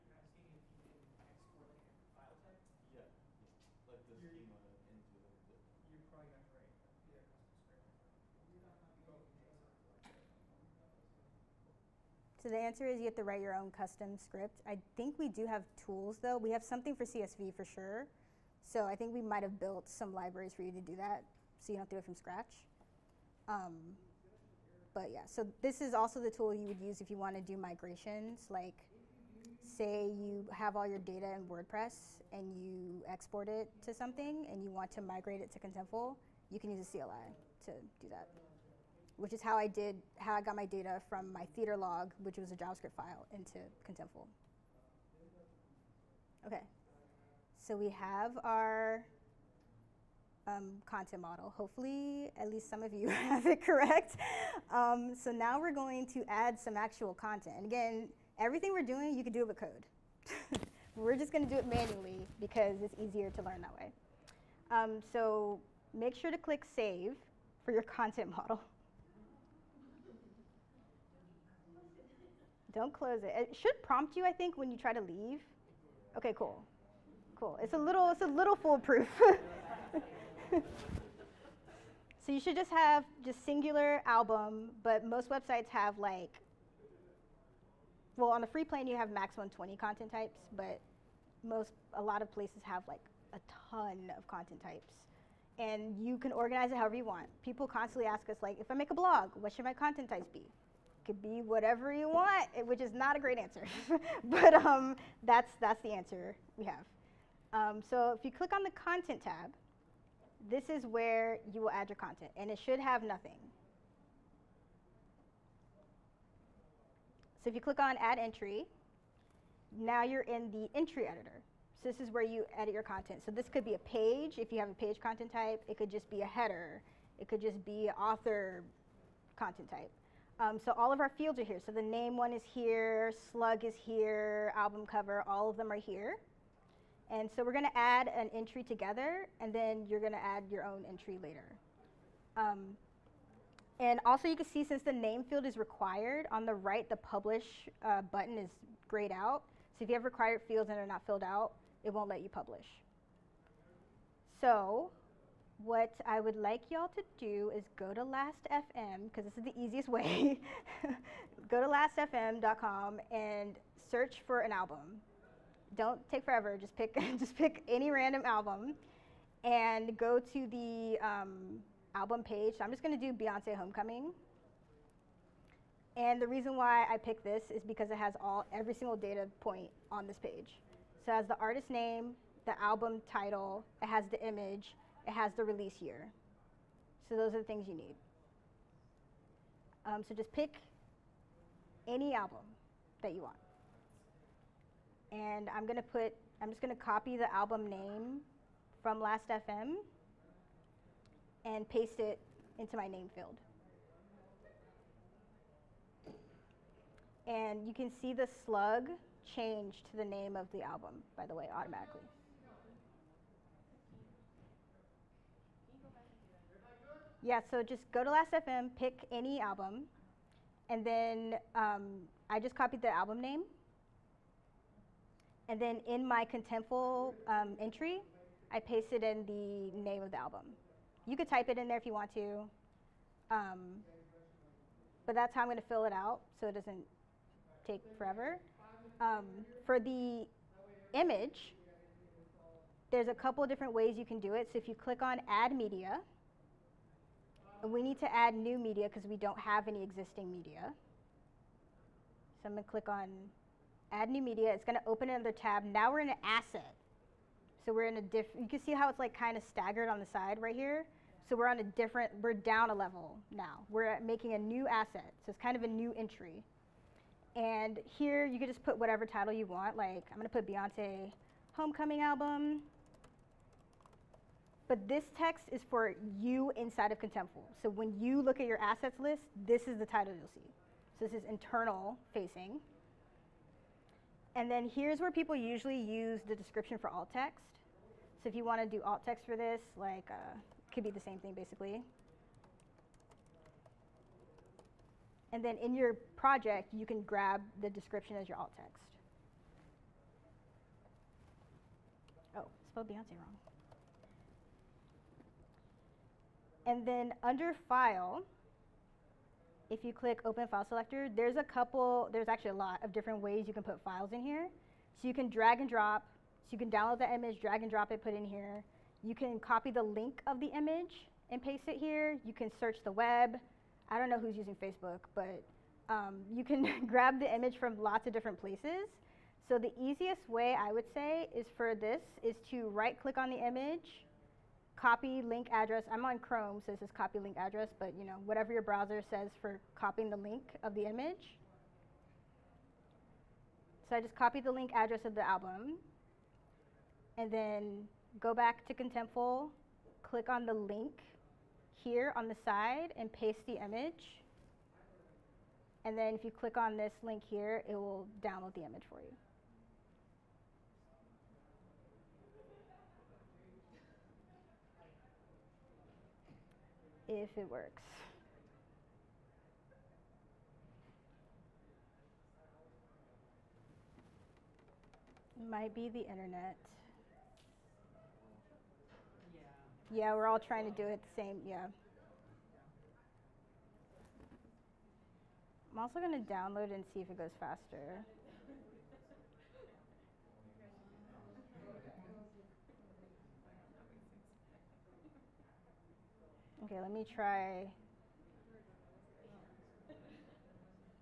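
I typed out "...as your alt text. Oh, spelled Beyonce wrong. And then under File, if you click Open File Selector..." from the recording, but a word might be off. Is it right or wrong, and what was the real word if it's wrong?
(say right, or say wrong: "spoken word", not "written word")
right.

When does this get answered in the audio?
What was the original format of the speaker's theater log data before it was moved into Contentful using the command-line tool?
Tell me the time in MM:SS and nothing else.
00:42.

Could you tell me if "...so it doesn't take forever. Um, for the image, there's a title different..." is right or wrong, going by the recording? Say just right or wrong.
wrong.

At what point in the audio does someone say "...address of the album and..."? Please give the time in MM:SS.
05:44.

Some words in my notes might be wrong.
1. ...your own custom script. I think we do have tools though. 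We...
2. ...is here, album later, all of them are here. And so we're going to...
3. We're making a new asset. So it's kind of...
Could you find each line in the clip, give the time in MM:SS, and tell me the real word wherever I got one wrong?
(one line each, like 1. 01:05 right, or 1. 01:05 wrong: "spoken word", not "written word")
1. 00:13 right
2. 02:13 wrong: "cover", not "later"
3. 04:23 right.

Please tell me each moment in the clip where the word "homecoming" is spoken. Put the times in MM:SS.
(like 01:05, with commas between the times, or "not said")
02:53, 04:31.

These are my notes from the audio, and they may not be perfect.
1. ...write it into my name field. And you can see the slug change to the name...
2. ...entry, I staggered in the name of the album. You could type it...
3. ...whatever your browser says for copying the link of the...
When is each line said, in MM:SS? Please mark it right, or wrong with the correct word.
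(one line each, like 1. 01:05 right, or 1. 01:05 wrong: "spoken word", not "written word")
1. 03:21 wrong: "paste", not "write"
2. 03:47 wrong: "pasted", not "staggered"
3. 05:38 right.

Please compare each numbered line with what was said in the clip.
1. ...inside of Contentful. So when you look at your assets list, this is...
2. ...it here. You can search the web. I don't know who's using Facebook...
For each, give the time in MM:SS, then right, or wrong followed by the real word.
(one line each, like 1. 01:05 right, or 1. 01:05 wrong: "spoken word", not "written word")
1. 04:36 right
2. 05:21 right.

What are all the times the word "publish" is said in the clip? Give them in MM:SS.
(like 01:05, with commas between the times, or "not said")
02:26, 02:32.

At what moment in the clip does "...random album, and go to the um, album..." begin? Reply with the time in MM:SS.
02:47.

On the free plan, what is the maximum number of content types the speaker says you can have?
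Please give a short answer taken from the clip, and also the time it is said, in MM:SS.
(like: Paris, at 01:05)
120, at 01:29.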